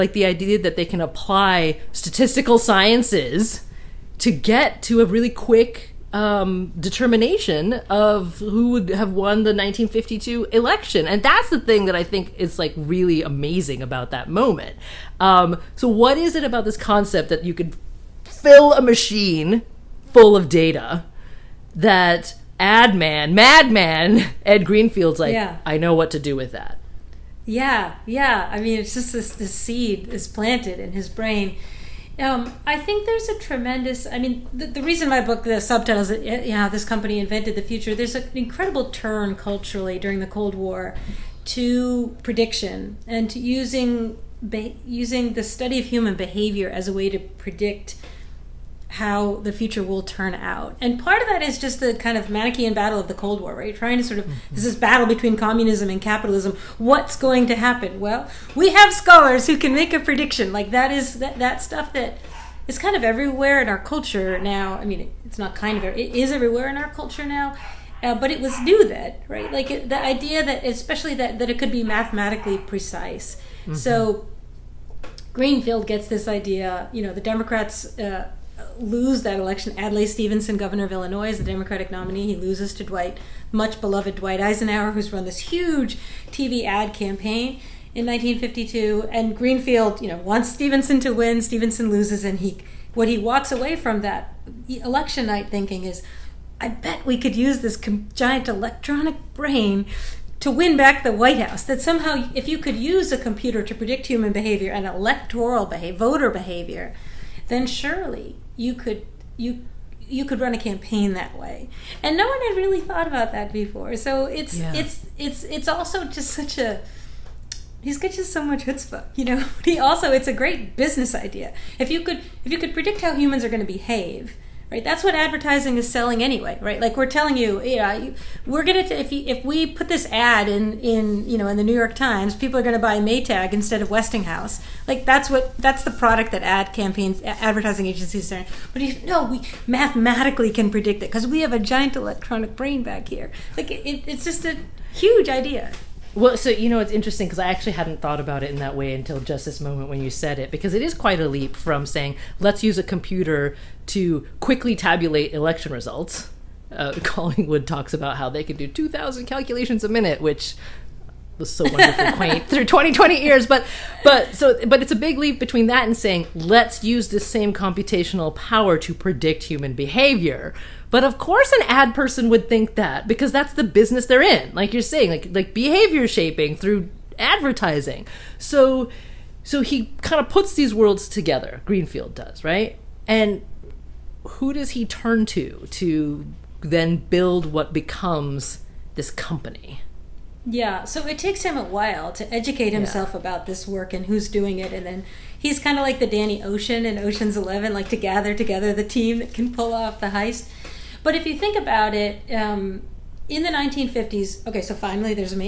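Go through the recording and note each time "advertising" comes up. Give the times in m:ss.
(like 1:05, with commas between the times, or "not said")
2:05, 2:17, 2:57.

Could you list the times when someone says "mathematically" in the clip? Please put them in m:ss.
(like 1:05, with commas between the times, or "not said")
1:11, 2:19.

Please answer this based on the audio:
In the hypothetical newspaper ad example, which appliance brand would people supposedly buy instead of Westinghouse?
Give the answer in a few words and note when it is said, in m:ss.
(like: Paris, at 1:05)
Maytag, at 2:12.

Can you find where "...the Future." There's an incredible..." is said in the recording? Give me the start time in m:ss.
0:37.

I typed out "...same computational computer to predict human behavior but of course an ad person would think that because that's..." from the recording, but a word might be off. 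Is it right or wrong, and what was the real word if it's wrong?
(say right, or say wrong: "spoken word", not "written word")
wrong: "power", not "computer".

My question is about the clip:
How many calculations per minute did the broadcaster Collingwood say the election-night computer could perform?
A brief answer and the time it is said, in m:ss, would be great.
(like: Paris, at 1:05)
2,000, at 2:38.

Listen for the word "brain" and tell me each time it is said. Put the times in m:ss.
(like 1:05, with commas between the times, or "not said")
0:31, 1:39, 2:22.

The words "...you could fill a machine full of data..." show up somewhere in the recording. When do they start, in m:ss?
0:17.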